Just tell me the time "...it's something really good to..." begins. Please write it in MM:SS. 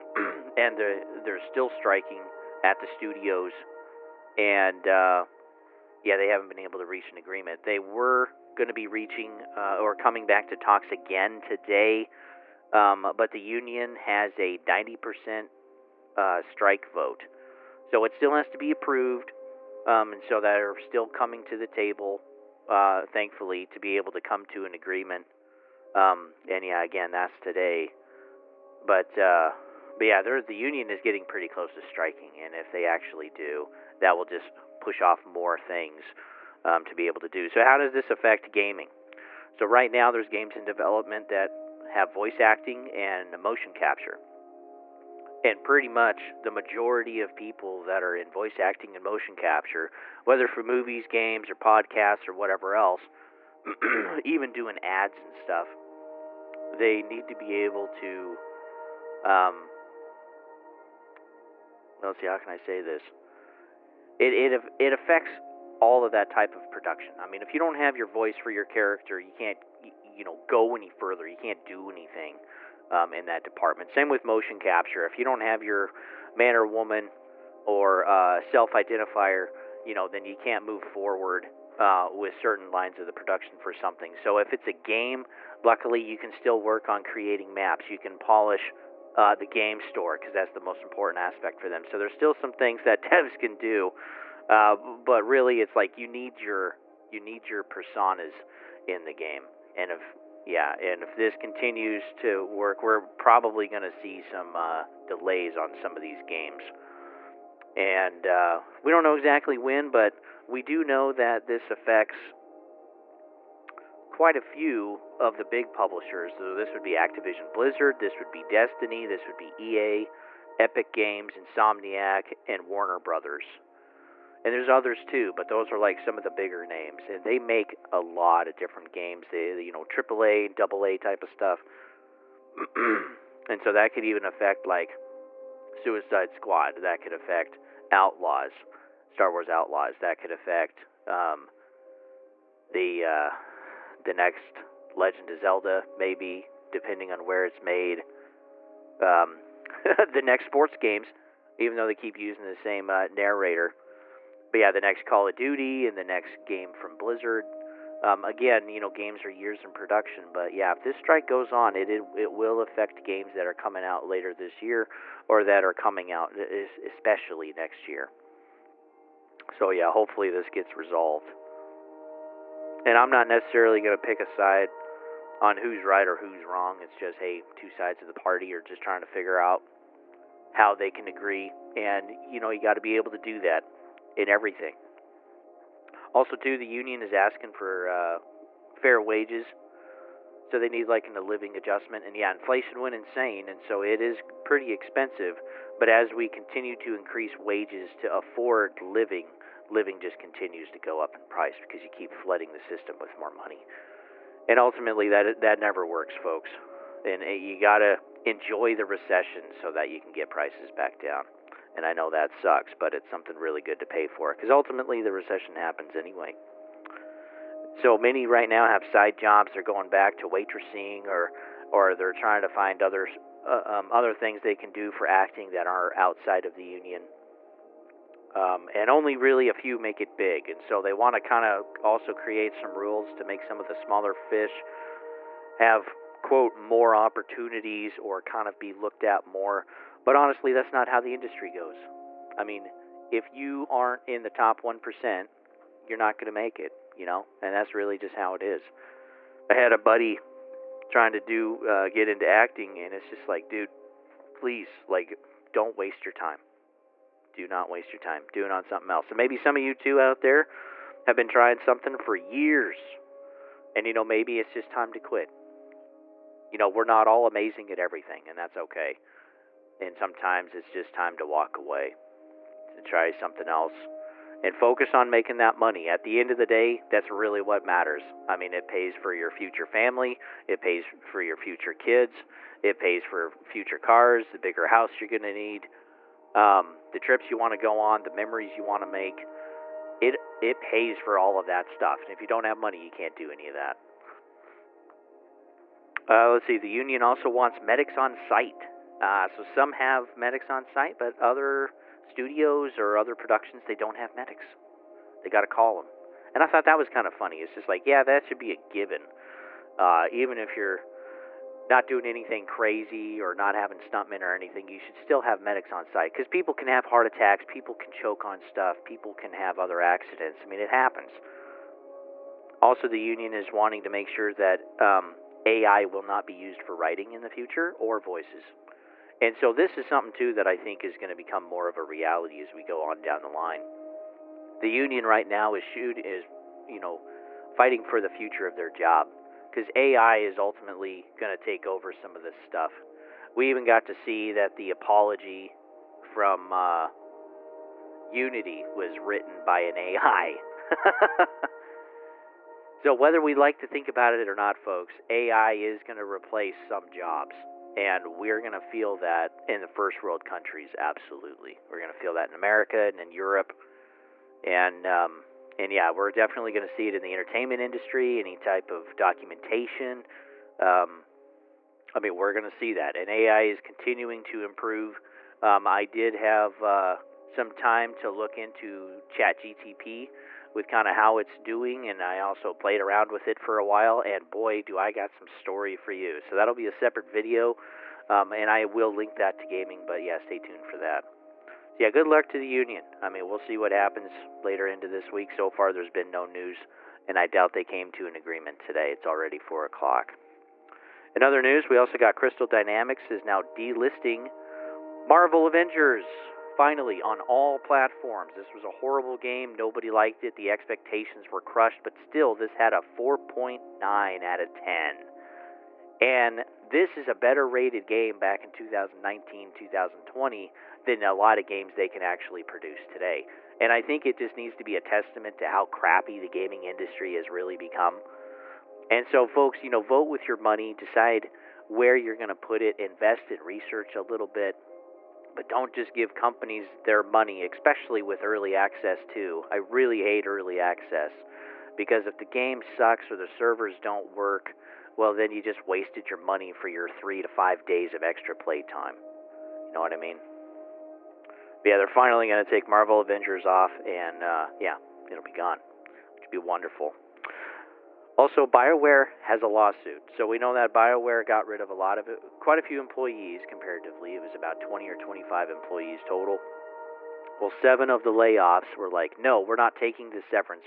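03:32.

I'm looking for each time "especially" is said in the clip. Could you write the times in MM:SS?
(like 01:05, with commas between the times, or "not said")
02:46, 07:17.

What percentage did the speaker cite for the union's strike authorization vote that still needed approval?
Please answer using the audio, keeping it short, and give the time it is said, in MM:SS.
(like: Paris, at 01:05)
90%, at 00:14.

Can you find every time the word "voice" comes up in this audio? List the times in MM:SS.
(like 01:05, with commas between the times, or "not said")
00:42, 00:48, 01:08, 05:27.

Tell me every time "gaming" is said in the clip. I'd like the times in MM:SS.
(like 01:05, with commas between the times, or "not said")
00:38, 06:29, 07:06.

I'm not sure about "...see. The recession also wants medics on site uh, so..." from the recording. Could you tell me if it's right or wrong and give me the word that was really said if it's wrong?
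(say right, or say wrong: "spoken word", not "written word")
wrong: "union", not "recession".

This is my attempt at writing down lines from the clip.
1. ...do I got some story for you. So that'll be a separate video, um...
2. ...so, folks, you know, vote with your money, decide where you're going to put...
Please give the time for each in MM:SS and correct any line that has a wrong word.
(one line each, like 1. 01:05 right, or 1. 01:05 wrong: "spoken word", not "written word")
1. 06:24 right
2. 07:09 right.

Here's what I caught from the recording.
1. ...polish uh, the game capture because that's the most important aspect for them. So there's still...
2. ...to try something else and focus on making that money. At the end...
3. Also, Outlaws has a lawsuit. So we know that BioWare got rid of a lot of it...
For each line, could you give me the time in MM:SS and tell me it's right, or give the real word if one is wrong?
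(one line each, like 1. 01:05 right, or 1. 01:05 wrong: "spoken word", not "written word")
1. 01:28 wrong: "store", not "capture"
2. 04:32 right
3. 07:38 wrong: "BioWare", not "Outlaws".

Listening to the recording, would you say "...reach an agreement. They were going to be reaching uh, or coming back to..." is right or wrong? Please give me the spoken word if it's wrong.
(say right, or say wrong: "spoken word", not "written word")
right.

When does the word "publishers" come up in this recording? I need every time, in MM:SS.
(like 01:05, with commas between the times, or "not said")
01:55.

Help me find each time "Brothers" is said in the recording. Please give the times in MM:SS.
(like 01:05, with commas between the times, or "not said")
02:02.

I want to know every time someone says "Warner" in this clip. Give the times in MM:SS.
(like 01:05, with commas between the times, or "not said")
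02:02.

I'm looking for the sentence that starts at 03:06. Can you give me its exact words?
Also, too, the union is asking for uh, fair wages, so they need like an, a living adjustment.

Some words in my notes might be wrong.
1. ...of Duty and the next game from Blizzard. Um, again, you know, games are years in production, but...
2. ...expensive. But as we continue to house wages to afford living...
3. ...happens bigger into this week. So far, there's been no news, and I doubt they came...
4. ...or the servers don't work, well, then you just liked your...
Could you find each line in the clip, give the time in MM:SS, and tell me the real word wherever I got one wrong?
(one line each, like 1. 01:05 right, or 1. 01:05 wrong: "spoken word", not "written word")
1. 02:35 right
2. 03:14 wrong: "increase", not "house"
3. 06:33 wrong: "later", not "bigger"
4. 07:23 wrong: "wasted", not "liked".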